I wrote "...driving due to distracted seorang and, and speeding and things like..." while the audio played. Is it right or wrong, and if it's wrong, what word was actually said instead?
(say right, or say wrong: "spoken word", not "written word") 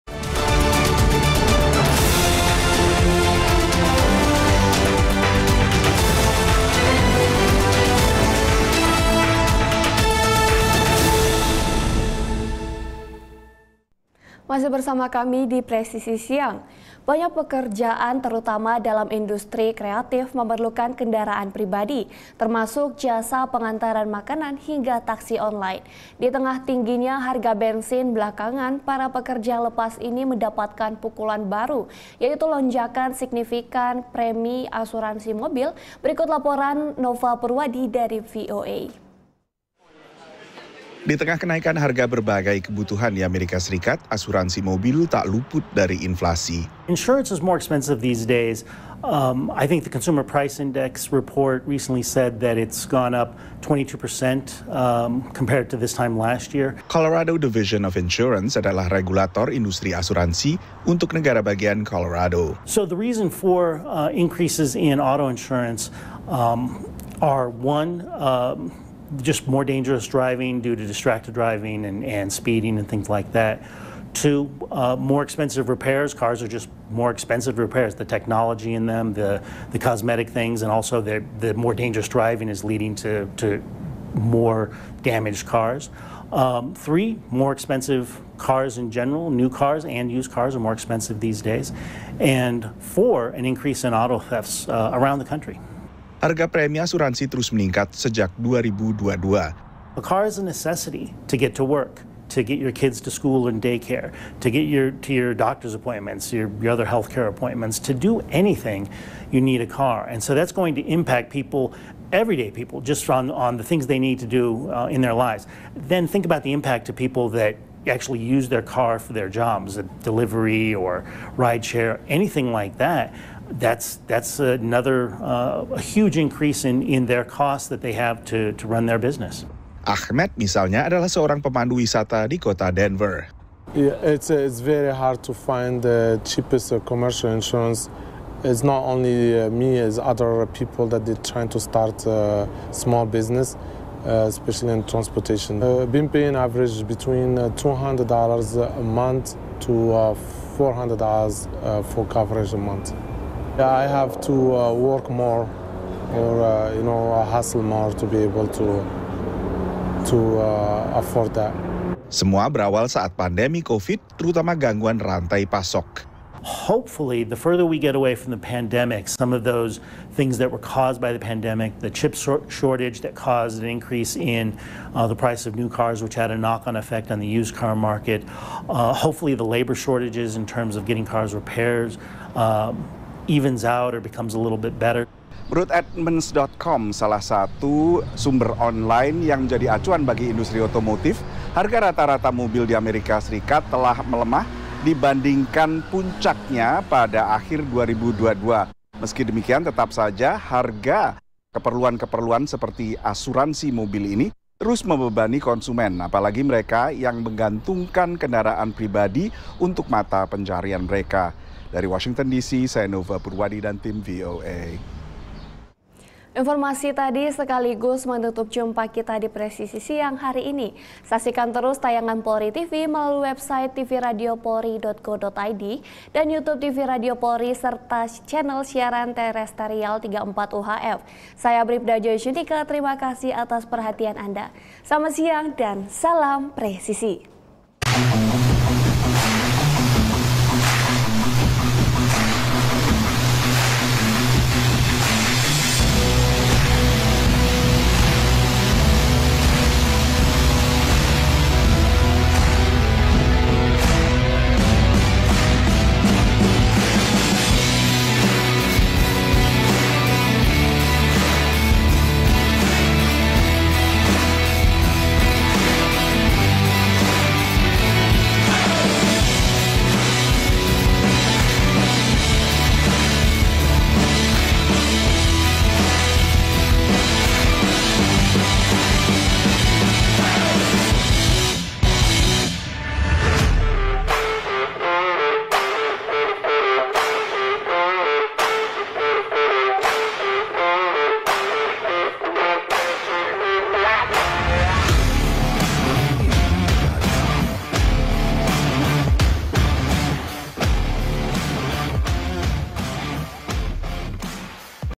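wrong: "driving", not "seorang".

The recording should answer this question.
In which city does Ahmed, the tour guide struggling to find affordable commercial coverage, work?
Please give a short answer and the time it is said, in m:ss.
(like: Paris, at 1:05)
Denver, at 2:12.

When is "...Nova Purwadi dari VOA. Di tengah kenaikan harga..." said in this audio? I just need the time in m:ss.
0:36.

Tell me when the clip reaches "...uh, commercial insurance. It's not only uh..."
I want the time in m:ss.
2:16.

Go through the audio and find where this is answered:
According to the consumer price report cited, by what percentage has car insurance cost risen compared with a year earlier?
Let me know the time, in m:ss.
0:53.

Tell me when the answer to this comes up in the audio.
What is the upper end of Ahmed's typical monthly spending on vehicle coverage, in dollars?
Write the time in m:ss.
2:30.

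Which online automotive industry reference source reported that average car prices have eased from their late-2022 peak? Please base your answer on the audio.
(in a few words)
Edmunds.com.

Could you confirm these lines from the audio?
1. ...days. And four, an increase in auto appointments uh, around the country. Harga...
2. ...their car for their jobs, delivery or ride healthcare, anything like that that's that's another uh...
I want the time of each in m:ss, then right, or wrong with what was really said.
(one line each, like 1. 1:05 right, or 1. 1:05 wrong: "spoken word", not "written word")
1. 1:31 wrong: "thefts", not "appointments"
2. 1:58 wrong: "share", not "healthcare".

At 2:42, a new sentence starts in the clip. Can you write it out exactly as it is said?
Semua berawal saat pandemi COVID, terutama gangguan rantai pasok.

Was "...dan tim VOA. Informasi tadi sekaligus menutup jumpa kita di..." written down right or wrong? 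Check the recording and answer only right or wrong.
right.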